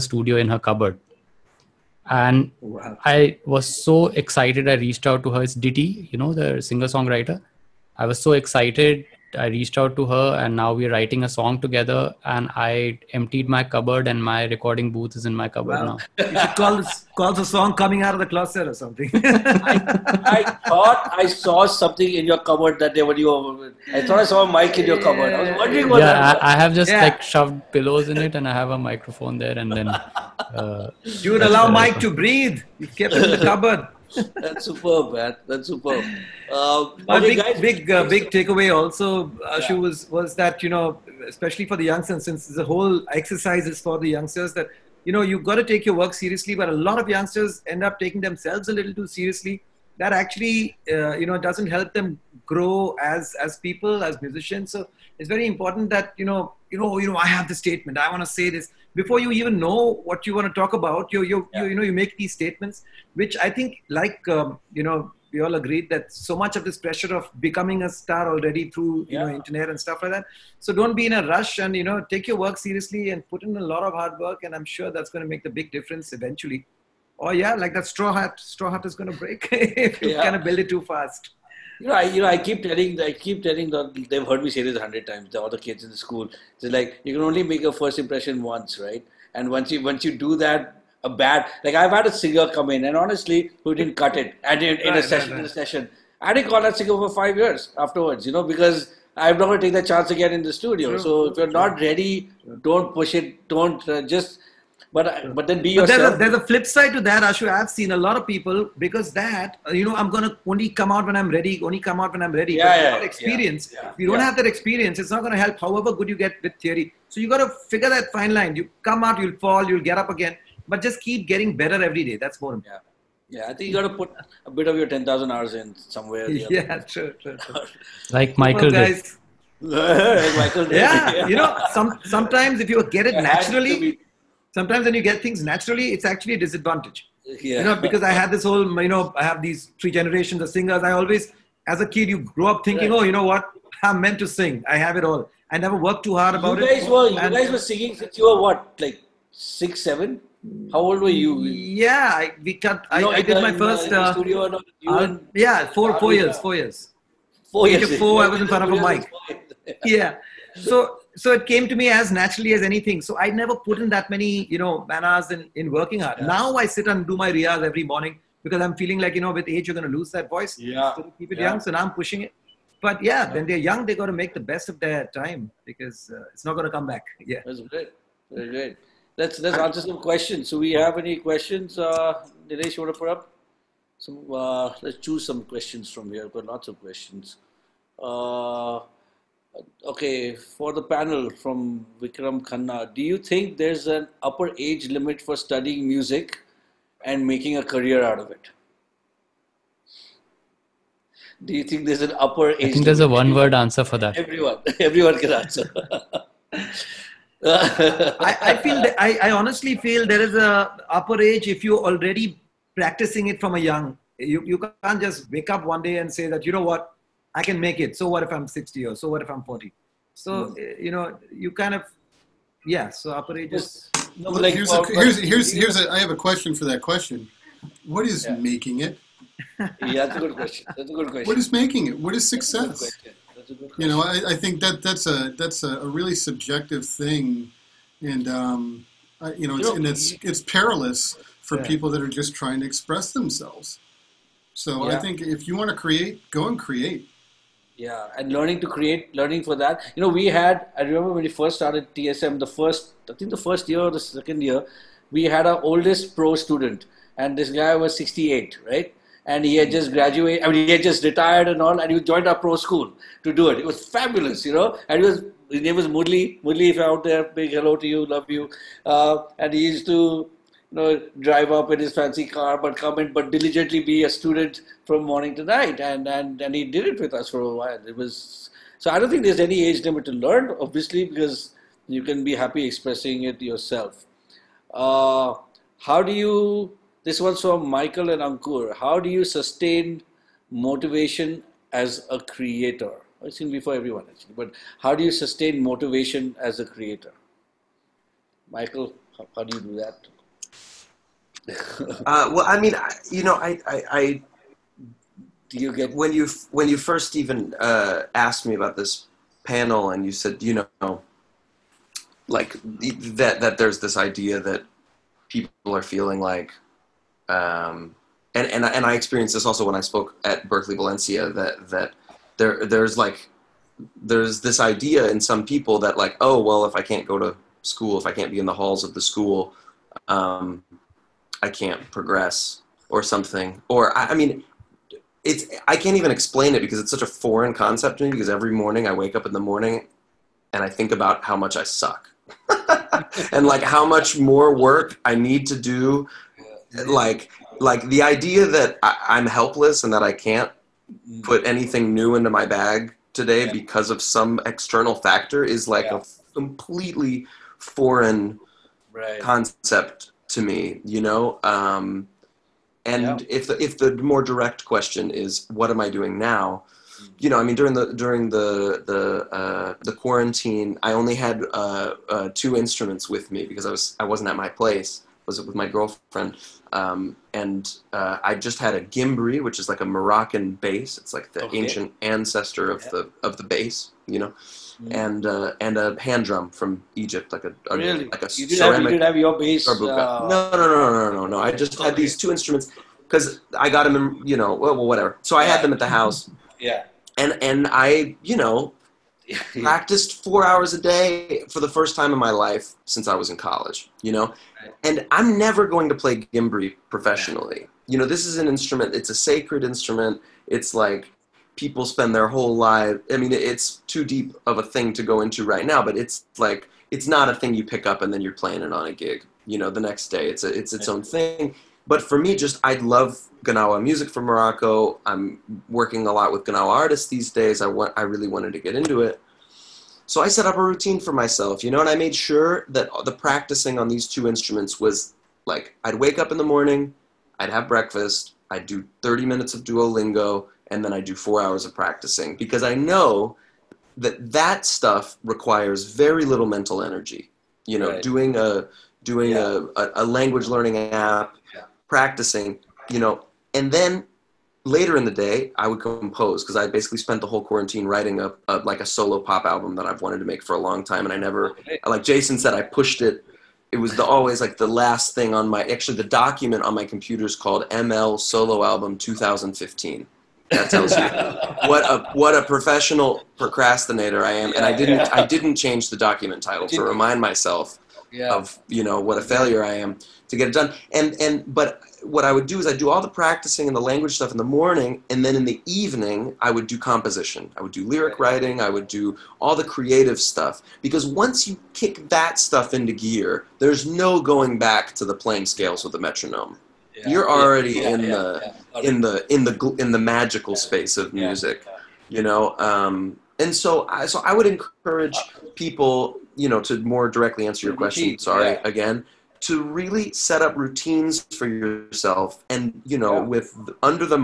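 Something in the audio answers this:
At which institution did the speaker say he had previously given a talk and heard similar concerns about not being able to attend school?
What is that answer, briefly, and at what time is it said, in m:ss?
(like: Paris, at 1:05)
Berklee Valencia, at 5:20.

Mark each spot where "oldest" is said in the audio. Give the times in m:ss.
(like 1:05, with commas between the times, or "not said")
4:15.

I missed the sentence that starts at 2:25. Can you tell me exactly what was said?
I never worked too hard about you guys it.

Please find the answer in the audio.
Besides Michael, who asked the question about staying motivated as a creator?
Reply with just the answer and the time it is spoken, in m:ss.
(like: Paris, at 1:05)
Ankur, at 4:48.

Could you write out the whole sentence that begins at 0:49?
That actually, uh, you know, doesn't help them grow as as people, as musicians.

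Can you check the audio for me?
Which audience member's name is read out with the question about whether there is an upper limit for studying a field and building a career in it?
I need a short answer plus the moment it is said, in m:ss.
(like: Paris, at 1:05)
Vikram Khanna, at 3:12.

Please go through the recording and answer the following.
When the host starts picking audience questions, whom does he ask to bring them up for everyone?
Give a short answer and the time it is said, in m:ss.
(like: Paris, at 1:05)
Dinesh, at 3:02.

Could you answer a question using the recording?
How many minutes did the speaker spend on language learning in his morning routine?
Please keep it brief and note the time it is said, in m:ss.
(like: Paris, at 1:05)
30, at 7:19.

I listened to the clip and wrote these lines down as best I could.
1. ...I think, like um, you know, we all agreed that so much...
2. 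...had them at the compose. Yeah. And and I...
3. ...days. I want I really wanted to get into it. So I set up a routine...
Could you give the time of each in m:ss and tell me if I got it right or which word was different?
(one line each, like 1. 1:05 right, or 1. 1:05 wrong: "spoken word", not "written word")
1. 1:03 right
2. 6:35 wrong: "house", not "compose"
3. 7:07 right.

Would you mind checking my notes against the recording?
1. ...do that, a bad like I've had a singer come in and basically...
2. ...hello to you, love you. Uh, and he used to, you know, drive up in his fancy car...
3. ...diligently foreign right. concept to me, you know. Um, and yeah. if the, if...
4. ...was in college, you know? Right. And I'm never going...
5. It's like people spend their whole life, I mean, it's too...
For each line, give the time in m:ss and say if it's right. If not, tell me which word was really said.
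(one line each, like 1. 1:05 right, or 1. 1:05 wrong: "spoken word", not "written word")
1. 1:30 wrong: "honestly", not "basically"
2. 4:27 right
3. 5:56 wrong: "completely", not "diligently"
4. 6:43 right
5. 6:50 right.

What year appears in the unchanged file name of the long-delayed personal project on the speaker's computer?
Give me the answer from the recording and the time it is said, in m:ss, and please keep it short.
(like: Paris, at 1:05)
2015, at 7:48.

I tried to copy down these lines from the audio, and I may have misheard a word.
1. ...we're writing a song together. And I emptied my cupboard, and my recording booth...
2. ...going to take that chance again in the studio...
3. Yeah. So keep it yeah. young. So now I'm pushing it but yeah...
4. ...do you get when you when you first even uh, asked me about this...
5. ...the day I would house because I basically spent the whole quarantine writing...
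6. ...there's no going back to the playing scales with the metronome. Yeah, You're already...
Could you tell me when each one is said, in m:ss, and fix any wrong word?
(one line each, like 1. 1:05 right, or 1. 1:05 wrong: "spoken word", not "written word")
1. 0:10 right
2. 1:39 right
3. 2:50 right
4. 5:05 right
5. 7:35 wrong: "compose", not "house"
6. 8:13 right.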